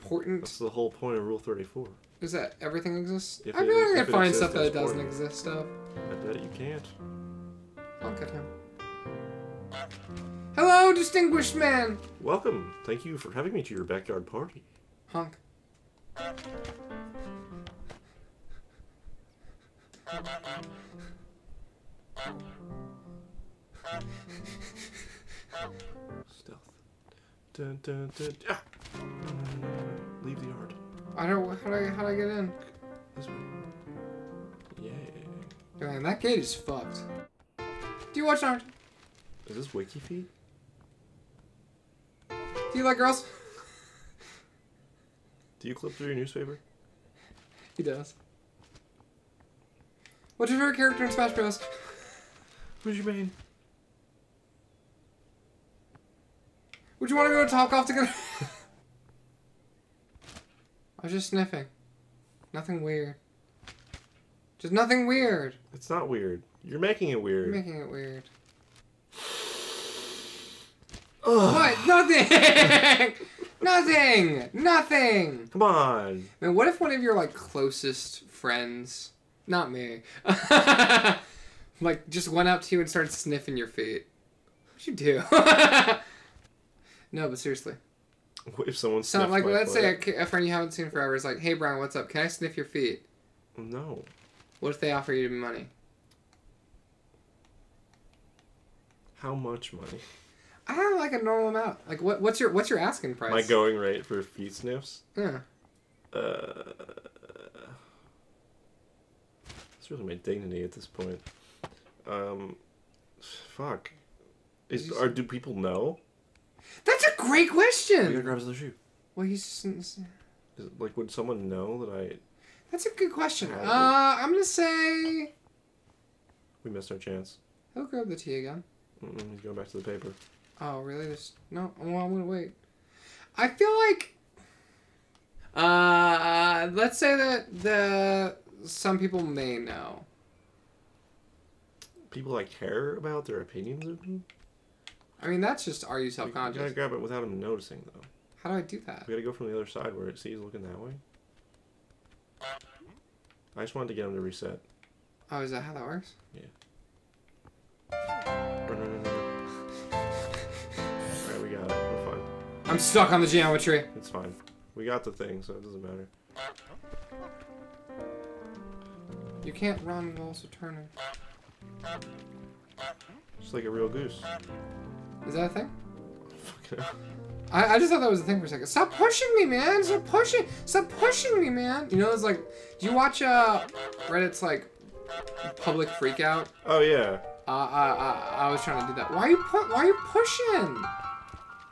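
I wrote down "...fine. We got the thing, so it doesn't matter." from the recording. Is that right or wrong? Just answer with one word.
right.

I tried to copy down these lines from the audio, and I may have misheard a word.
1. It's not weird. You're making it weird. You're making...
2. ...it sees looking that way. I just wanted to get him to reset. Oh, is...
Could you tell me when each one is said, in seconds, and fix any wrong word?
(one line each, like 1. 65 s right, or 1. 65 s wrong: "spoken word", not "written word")
1. 65 s right
2. 150 s right.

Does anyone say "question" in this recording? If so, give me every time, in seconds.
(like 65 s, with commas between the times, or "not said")
117 s, 123 s.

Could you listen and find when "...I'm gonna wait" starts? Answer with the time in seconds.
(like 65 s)
132 s.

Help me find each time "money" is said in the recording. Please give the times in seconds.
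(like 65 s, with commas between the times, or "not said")
95 s, 99 s.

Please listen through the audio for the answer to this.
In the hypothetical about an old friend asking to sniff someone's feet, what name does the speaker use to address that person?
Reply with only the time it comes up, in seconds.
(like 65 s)
91 s.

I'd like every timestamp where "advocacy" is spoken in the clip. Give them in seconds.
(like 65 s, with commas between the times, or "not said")
not said.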